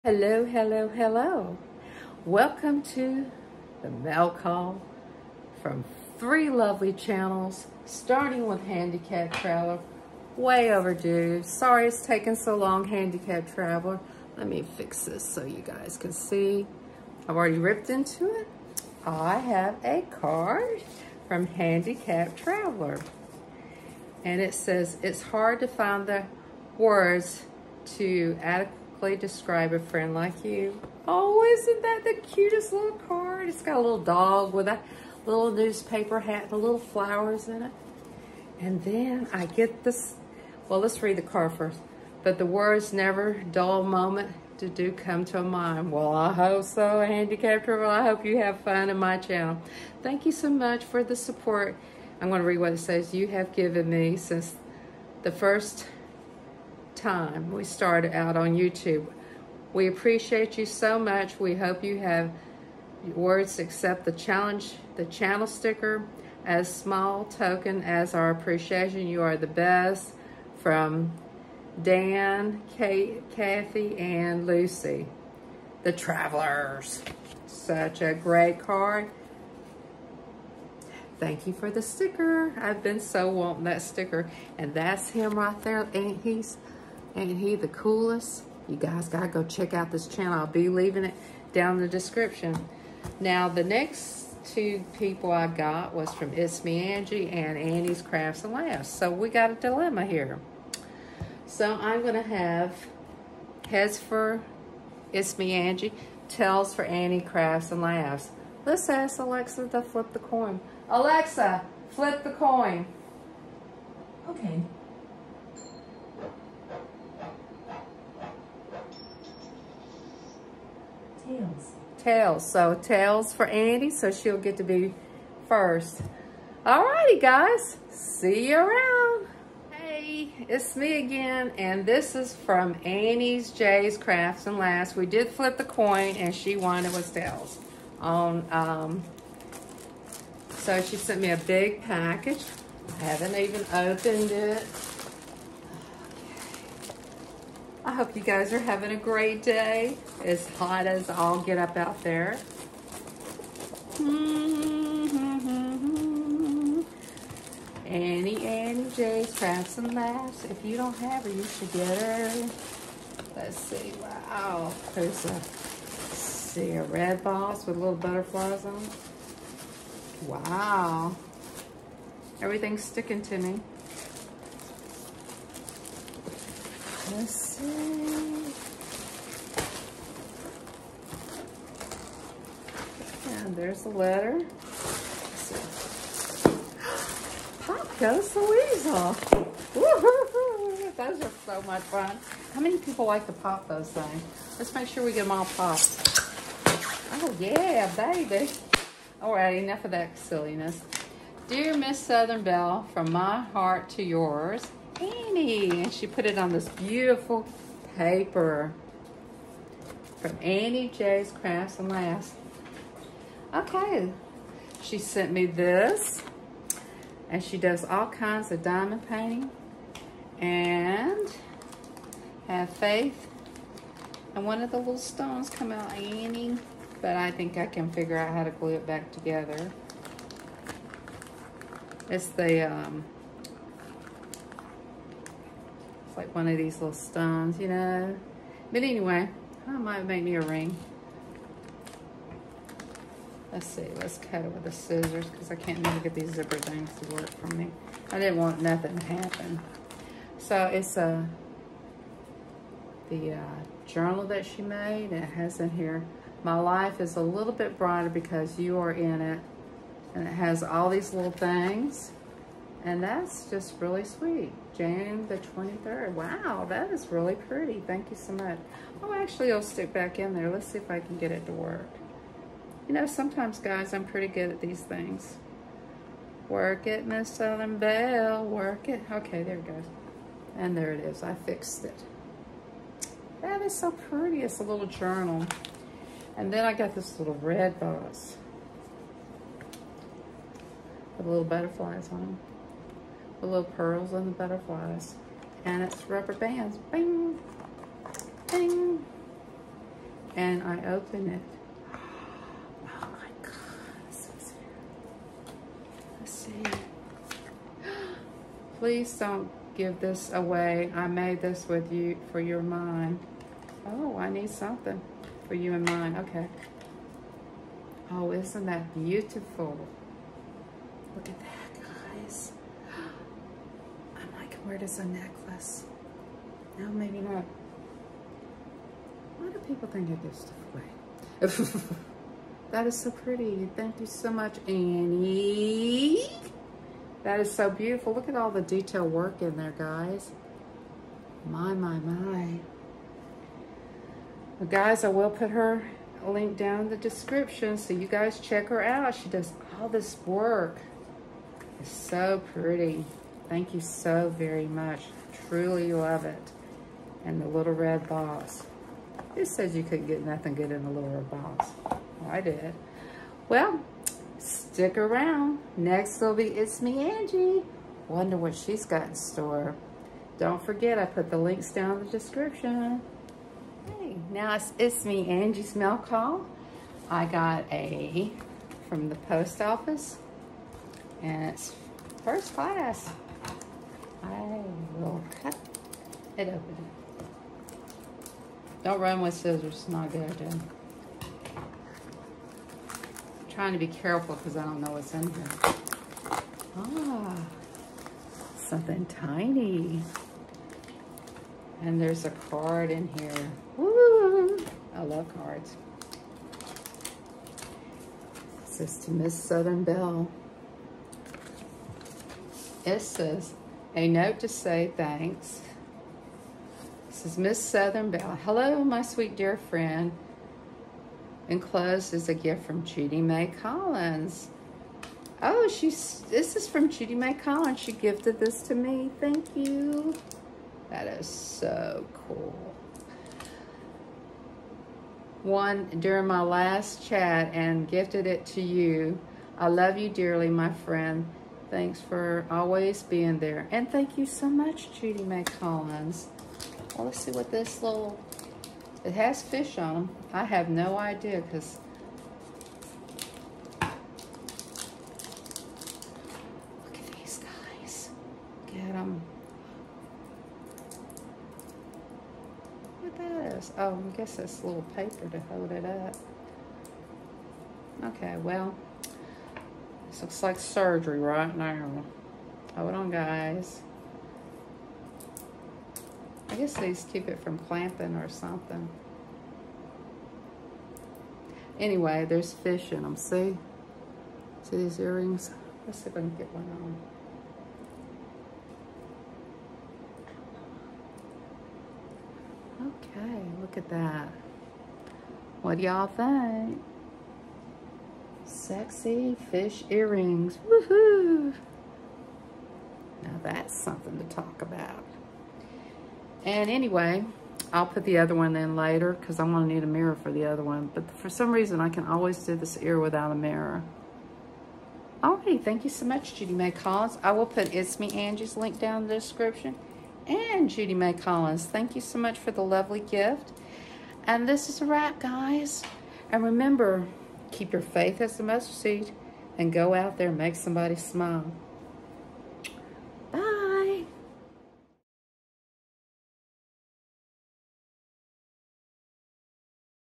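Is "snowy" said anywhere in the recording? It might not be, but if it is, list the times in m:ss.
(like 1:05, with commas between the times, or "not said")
not said.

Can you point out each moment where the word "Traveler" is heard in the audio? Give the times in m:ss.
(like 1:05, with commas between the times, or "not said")
0:09, 0:13, 0:22, 1:15.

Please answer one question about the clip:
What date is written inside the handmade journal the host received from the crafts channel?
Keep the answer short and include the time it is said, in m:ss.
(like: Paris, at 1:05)
June 23rd, at 4:24.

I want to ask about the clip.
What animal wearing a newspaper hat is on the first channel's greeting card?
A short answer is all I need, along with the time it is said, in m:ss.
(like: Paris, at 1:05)
Dog, at 0:34.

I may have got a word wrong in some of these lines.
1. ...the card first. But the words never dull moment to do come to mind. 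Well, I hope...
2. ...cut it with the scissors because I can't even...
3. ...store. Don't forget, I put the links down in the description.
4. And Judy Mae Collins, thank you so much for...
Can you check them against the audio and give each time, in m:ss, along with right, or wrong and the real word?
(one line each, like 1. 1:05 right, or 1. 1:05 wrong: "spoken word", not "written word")
1. 0:41 right
2. 4:04 right
3. 6:09 right
4. 8:40 right.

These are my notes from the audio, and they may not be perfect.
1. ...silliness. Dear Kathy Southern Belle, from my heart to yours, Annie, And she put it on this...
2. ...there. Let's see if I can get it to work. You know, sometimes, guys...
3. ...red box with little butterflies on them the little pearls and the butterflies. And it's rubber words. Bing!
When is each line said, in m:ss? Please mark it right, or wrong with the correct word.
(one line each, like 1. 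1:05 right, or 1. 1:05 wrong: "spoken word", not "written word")
1. 3:20 wrong: "Miss", not "Kathy"
2. 4:30 right
3. 4:47 wrong: "bands", not "words".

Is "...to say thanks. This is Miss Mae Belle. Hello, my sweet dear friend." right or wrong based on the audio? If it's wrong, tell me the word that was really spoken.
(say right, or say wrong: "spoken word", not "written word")
wrong: "Southern", not "Mae".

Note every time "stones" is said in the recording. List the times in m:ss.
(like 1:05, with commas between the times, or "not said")
3:44, 3:56.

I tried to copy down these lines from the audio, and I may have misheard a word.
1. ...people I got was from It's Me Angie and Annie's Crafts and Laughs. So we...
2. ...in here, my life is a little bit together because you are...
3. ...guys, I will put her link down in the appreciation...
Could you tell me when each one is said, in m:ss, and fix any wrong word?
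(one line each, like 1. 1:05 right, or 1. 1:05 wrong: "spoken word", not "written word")
1. 1:34 right
2. 4:15 wrong: "brighter", not "together"
3. 5:44 wrong: "description", not "appreciation".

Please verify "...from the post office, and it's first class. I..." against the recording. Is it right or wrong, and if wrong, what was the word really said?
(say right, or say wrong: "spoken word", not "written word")
right.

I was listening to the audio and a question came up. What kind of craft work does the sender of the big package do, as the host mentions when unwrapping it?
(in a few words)
Diamond painting.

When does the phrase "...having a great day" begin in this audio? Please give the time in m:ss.
2:28.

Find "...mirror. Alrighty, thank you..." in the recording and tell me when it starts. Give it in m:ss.
8:33.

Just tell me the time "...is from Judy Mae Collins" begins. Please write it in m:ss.
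7:06.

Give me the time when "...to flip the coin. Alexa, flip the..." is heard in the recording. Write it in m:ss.
1:49.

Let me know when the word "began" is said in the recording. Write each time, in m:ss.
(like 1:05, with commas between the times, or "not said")
not said.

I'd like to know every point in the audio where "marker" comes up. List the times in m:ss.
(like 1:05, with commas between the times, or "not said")
not said.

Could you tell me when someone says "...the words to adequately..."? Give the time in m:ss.
0:26.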